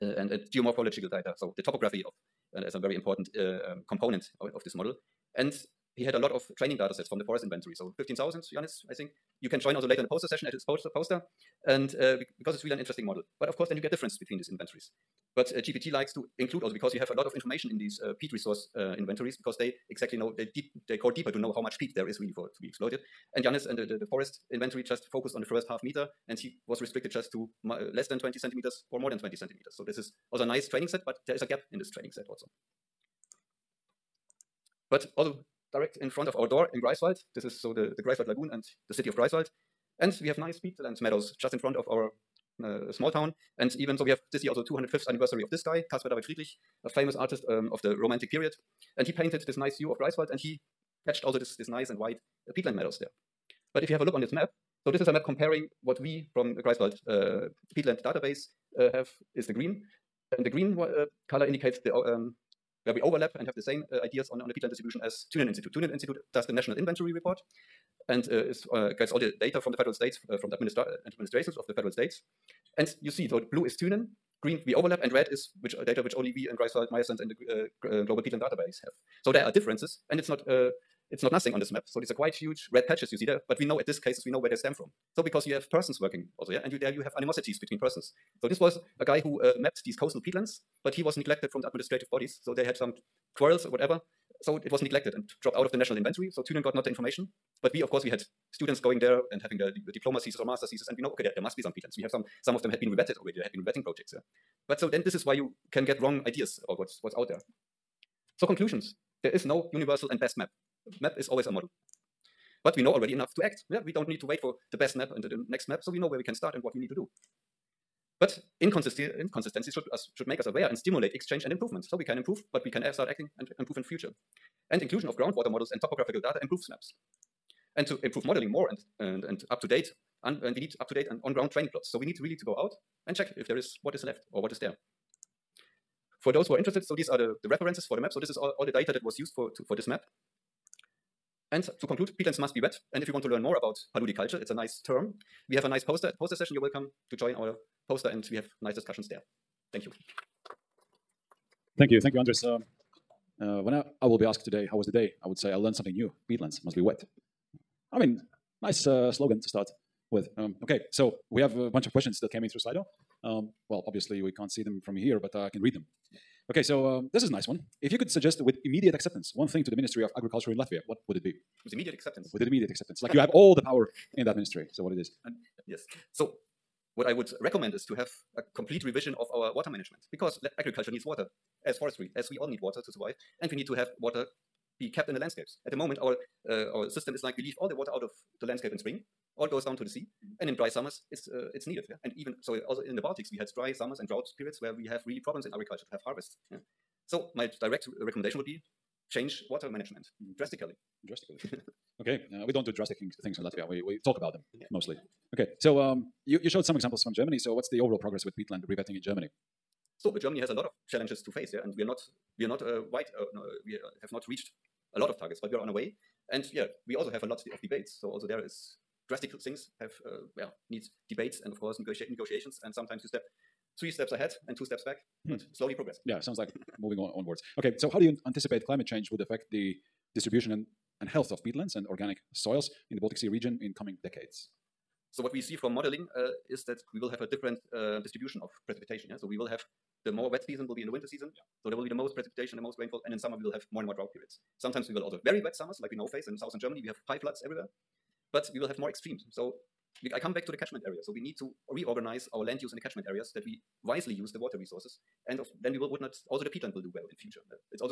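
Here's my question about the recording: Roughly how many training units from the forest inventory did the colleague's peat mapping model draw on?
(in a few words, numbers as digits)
15,000.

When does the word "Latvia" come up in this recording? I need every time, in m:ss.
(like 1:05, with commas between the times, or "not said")
2:50, 3:23.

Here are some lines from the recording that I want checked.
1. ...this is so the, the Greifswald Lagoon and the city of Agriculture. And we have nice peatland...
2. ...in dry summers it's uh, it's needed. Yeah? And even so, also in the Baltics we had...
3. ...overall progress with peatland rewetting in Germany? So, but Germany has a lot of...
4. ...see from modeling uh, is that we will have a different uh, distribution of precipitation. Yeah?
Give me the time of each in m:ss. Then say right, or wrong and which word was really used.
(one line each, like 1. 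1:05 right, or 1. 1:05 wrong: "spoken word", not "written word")
1. 0:37 wrong: "Greifswald", not "Agriculture"
2. 3:10 right
3. 3:27 right
4. 3:55 right.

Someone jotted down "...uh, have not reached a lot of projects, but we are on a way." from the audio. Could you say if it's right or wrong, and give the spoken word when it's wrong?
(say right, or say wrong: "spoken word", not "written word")
wrong: "targets", not "projects".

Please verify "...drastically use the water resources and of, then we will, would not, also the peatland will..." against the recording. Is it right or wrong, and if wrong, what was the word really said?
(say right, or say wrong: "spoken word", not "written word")
wrong: "wisely", not "drastically".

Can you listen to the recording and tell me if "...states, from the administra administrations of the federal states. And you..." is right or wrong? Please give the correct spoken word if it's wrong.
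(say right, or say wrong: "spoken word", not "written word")
right.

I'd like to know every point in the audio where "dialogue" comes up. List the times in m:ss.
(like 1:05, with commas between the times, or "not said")
not said.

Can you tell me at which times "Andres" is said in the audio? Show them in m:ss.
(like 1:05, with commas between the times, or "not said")
2:32.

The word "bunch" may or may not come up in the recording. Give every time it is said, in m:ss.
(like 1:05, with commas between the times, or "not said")
2:41.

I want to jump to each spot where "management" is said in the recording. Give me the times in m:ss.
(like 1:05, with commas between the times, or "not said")
2:59, 3:19.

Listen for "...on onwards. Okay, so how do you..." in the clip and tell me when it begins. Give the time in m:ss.
3:46.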